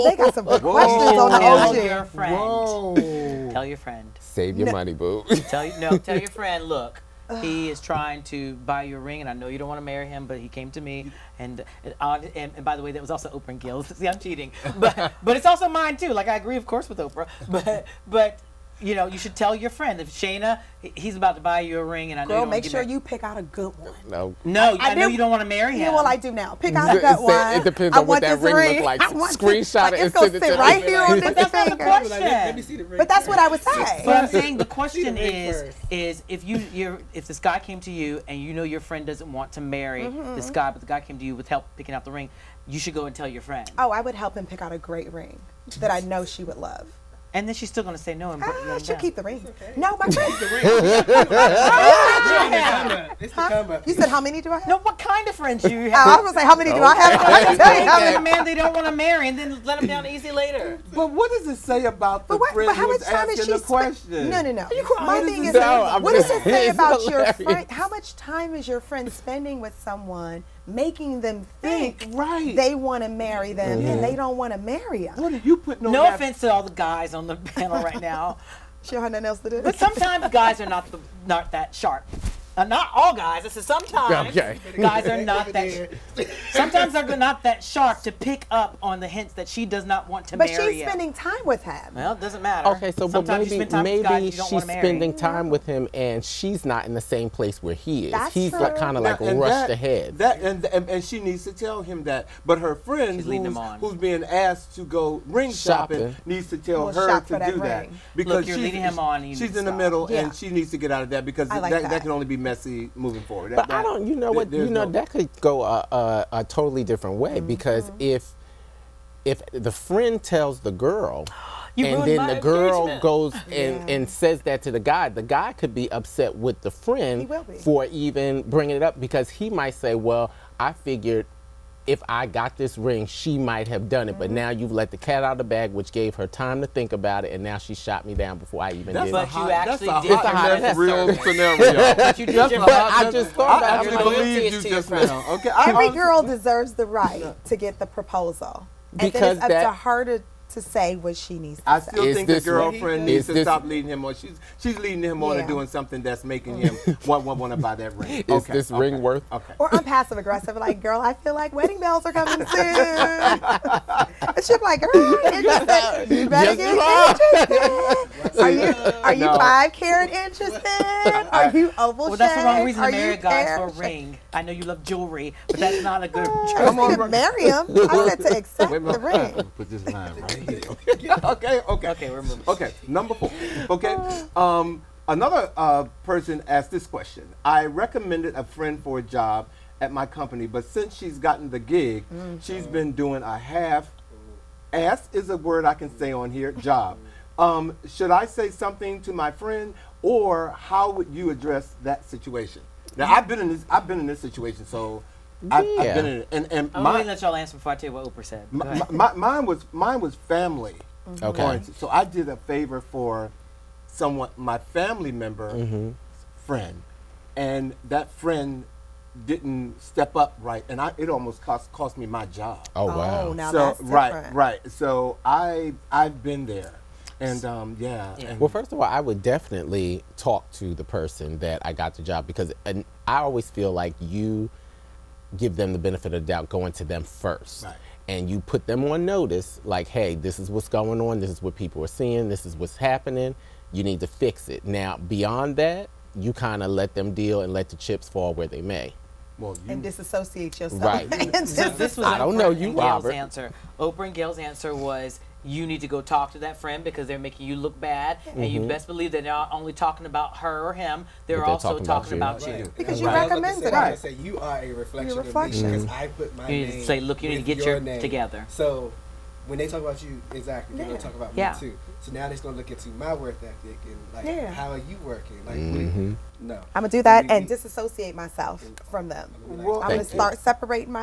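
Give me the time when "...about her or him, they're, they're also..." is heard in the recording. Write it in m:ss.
4:20.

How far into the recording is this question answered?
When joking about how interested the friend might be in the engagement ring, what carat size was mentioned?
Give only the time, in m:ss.
2:49.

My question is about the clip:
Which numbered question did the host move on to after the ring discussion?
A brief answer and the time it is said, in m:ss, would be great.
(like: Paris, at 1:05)
4, at 3:02.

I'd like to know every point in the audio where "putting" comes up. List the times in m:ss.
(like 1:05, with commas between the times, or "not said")
1:15.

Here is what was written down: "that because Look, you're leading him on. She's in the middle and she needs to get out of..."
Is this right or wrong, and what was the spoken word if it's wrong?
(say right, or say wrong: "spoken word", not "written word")
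right.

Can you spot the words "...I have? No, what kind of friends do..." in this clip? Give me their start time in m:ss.
0:54.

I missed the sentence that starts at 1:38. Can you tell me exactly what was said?
That's He's like kind of like rushed that, ahead.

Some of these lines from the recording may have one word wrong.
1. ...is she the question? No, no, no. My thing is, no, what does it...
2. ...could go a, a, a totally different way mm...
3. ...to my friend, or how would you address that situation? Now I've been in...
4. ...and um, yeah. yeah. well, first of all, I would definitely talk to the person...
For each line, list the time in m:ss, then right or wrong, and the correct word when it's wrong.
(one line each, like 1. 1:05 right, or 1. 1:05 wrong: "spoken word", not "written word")
1. 1:03 right
2. 1:55 right
3. 3:19 right
4. 3:47 right.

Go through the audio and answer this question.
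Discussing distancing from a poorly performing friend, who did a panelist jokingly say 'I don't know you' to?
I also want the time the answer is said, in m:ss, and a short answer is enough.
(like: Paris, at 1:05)
Robert, at 4:12.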